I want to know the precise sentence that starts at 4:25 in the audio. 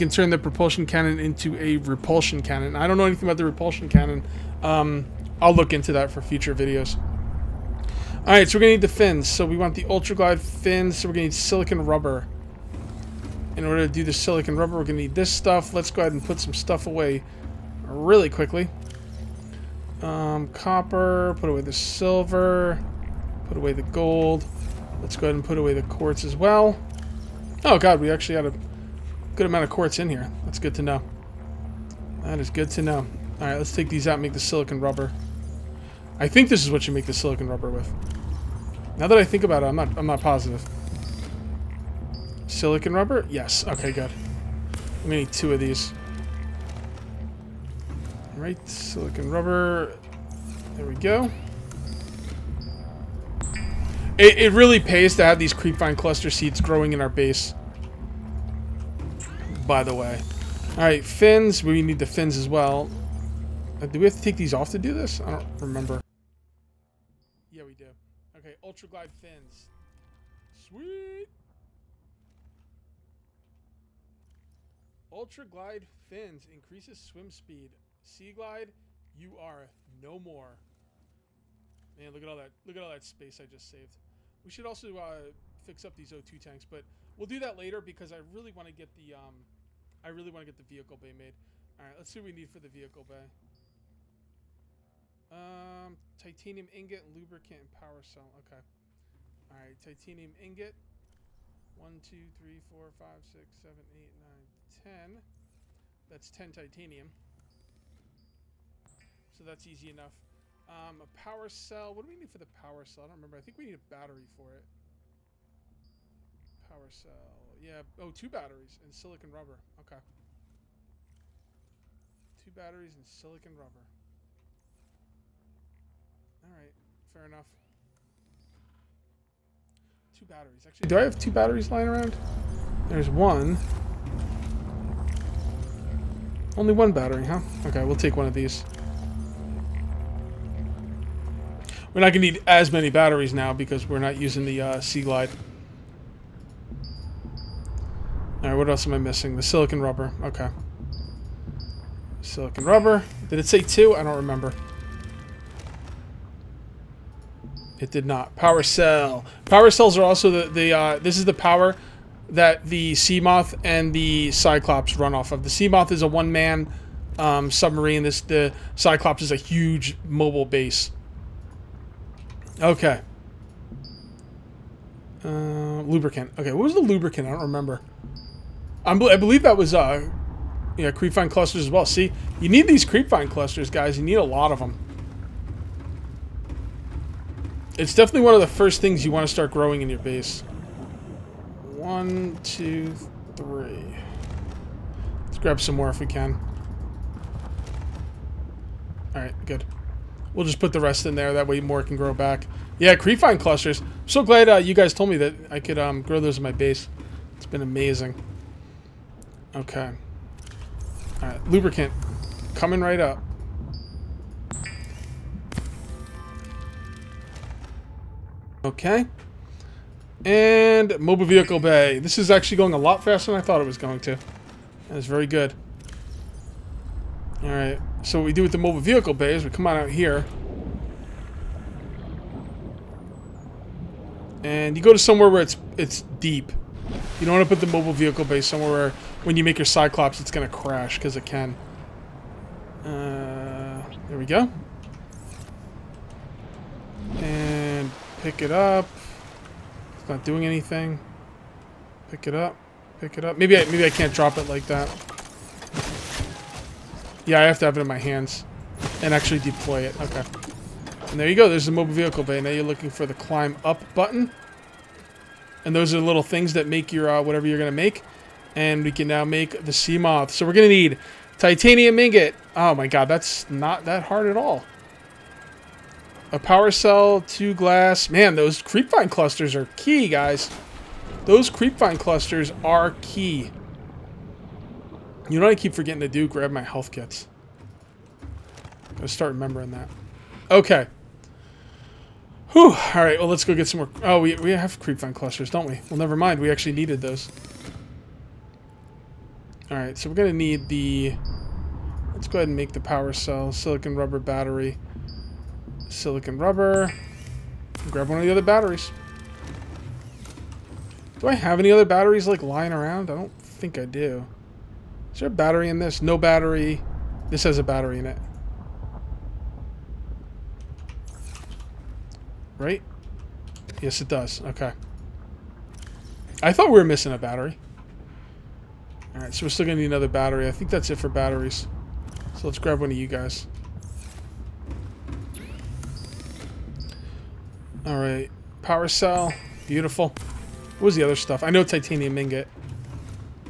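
And those are the little things that make your uh, whatever you're going to make.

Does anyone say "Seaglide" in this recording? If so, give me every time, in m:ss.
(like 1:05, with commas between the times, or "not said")
1:18, 2:24.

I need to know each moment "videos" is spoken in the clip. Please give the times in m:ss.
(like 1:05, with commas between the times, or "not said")
0:06.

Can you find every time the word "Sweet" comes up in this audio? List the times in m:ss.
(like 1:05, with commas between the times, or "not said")
1:10.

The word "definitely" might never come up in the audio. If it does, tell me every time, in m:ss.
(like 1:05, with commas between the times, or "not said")
3:07.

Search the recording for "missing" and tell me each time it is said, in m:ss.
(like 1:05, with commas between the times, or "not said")
2:28, 5:26.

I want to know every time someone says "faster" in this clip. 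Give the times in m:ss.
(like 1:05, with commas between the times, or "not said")
3:43.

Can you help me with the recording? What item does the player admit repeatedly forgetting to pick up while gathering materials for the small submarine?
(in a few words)
health kits.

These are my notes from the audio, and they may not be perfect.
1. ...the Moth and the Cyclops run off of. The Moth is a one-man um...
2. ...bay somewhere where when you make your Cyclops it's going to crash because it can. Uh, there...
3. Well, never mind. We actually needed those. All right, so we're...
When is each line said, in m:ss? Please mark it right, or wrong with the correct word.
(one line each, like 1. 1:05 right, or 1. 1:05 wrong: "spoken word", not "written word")
1. 2:42 right
2. 3:58 right
3. 4:55 right.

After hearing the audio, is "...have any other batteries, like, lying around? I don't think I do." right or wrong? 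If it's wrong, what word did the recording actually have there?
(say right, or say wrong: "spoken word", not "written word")
right.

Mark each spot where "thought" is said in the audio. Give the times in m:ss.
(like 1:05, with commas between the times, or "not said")
3:43, 5:26.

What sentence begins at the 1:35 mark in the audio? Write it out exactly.
Um, titanium ingot, lubricant, and power cell.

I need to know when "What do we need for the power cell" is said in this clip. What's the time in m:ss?
1:51.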